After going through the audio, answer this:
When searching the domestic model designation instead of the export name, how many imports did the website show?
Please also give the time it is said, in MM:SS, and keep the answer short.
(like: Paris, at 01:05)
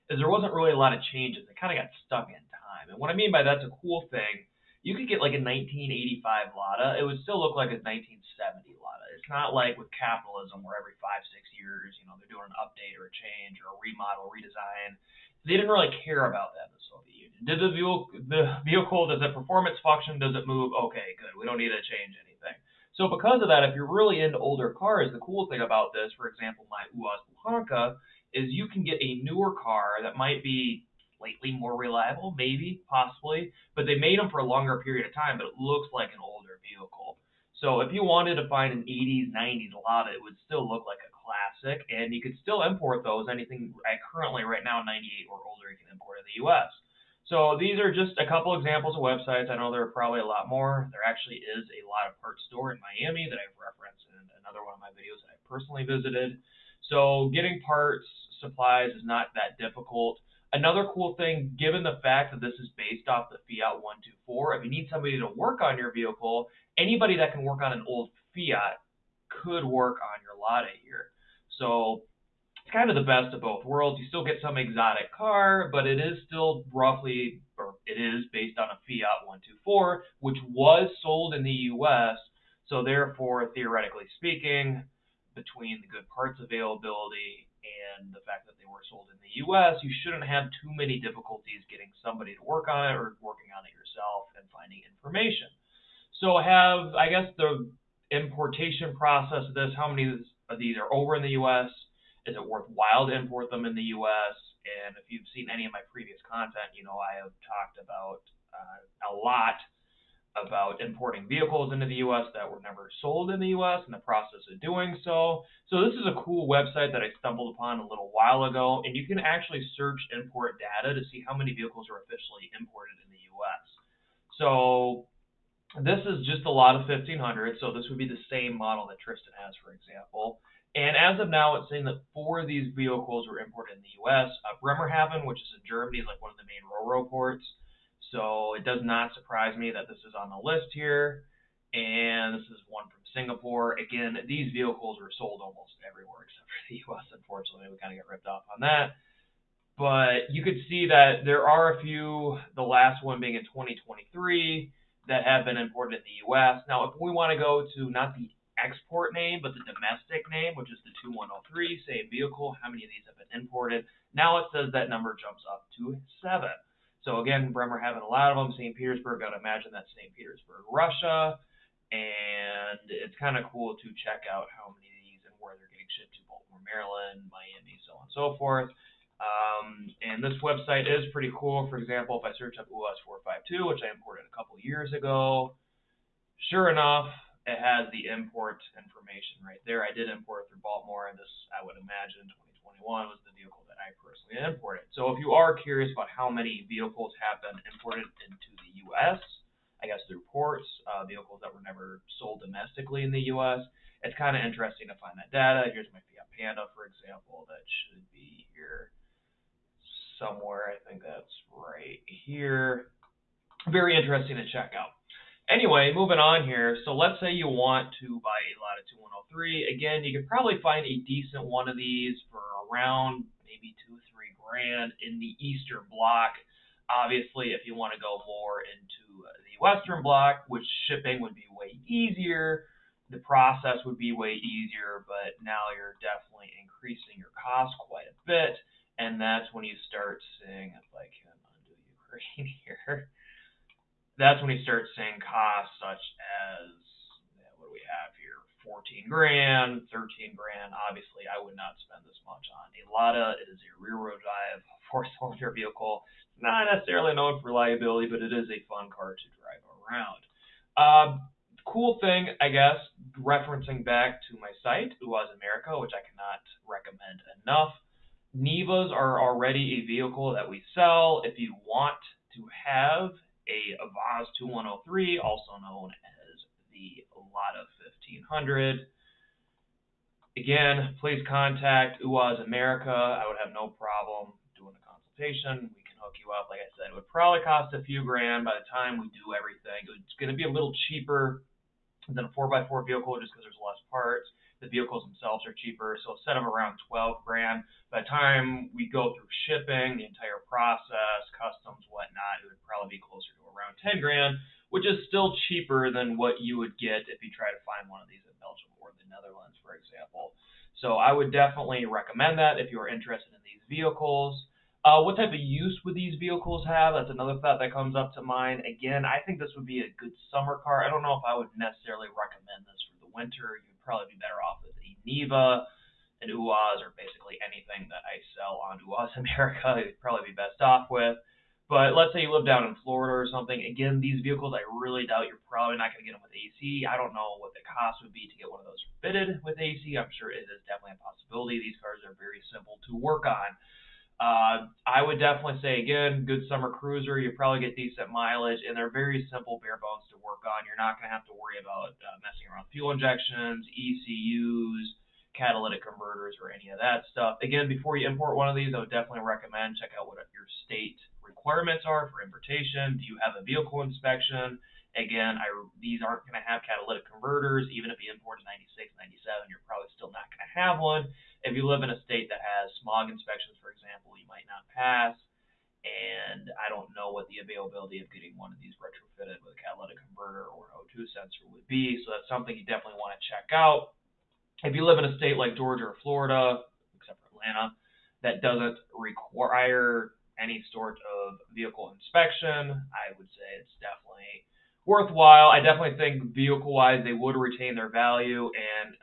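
7, at 02:46.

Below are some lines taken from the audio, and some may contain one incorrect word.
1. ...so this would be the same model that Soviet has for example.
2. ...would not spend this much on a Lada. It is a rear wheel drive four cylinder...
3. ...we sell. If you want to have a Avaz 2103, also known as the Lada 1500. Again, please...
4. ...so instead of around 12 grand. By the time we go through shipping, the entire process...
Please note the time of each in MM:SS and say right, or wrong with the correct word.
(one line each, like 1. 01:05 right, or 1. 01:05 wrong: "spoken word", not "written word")
1. 02:07 wrong: "Tristan", not "Soviet"
2. 04:11 right
3. 04:30 right
4. 04:56 right.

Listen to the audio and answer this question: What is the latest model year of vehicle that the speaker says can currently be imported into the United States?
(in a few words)
1998.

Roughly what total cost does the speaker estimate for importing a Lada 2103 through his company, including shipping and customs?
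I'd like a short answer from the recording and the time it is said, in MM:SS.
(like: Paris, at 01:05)
10 grand, at 05:03.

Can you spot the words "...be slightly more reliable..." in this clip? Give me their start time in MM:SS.
00:30.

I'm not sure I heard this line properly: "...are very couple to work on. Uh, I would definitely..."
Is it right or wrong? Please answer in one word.
wrong.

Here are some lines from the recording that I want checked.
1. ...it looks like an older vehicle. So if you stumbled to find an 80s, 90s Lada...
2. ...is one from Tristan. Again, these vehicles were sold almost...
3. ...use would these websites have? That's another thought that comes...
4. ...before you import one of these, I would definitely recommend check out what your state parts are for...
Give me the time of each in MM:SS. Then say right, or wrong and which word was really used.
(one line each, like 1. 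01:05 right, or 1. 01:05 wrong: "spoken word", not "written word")
1. 00:35 wrong: "wanted", not "stumbled"
2. 02:22 wrong: "Singapore", not "Tristan"
3. 05:15 wrong: "vehicles", not "websites"
4. 05:57 wrong: "requirements", not "parts".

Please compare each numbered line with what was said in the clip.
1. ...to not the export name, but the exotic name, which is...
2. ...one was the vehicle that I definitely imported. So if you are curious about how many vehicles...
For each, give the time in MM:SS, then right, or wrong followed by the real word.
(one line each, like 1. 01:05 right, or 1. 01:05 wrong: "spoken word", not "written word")
1. 02:37 wrong: "domestic", not "exotic"
2. 03:12 wrong: "personally", not "definitely".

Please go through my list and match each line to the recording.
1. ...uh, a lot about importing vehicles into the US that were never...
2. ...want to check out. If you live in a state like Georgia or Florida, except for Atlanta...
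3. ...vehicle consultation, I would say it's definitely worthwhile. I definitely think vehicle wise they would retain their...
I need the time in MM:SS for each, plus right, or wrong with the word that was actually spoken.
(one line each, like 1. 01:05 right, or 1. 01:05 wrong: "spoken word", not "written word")
1. 01:48 right
2. 06:23 right
3. 06:31 wrong: "inspection", not "consultation".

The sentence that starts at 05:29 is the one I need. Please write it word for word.
You'd probably be best off with.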